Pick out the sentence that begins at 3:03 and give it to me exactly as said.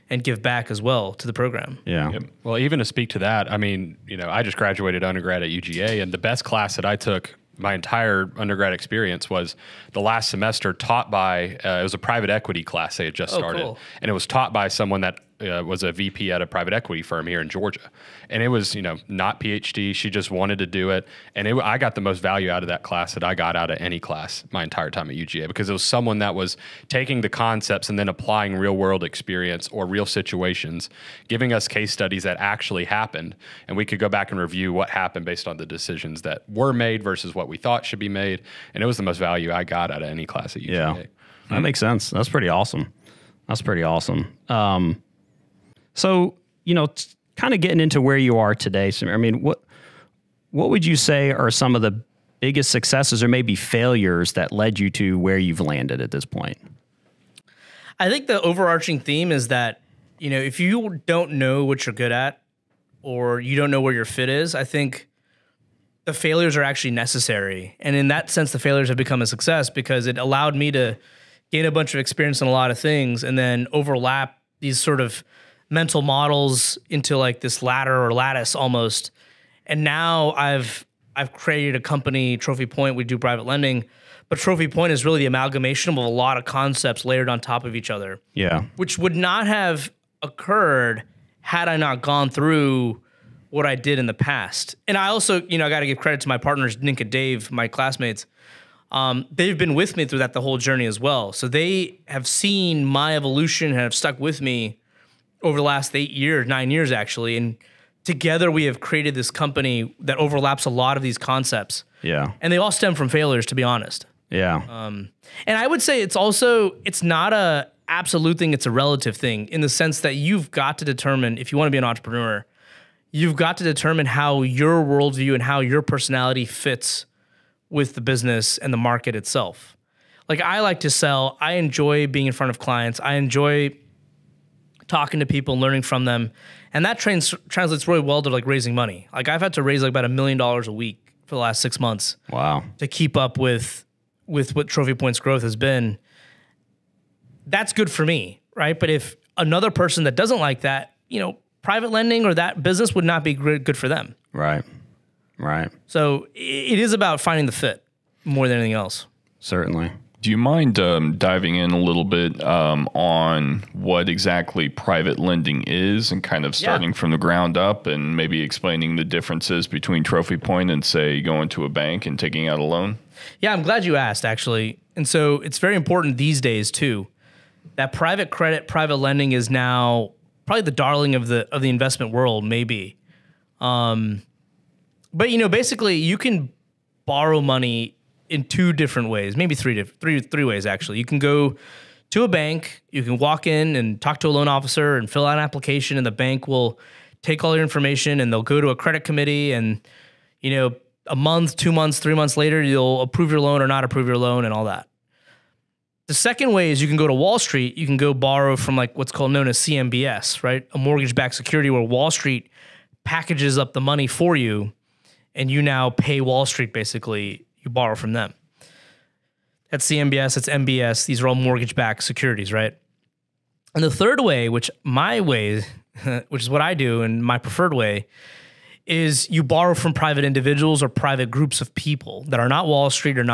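Um, but, you know, basically, you can borrow money in two different ways, maybe three, three, three ways actually.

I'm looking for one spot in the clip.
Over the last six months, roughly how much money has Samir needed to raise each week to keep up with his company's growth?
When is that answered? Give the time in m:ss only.
2:19.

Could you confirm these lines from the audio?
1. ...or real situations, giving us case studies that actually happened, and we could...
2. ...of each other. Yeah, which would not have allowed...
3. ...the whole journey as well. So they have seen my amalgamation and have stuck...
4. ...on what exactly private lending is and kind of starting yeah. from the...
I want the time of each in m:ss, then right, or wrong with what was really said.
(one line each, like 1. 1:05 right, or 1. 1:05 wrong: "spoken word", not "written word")
1. 0:29 right
2. 1:27 wrong: "occurred", not "allowed"
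3. 1:40 wrong: "evolution", not "amalgamation"
4. 2:42 right.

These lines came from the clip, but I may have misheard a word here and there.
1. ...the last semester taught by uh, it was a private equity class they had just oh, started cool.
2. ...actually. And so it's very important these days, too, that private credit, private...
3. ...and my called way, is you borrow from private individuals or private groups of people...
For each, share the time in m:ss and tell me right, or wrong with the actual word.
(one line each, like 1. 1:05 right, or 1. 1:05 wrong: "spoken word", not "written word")
1. 0:09 right
2. 2:54 right
3. 3:47 wrong: "preferred", not "called".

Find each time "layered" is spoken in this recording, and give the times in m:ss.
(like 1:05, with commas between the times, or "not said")
1:27.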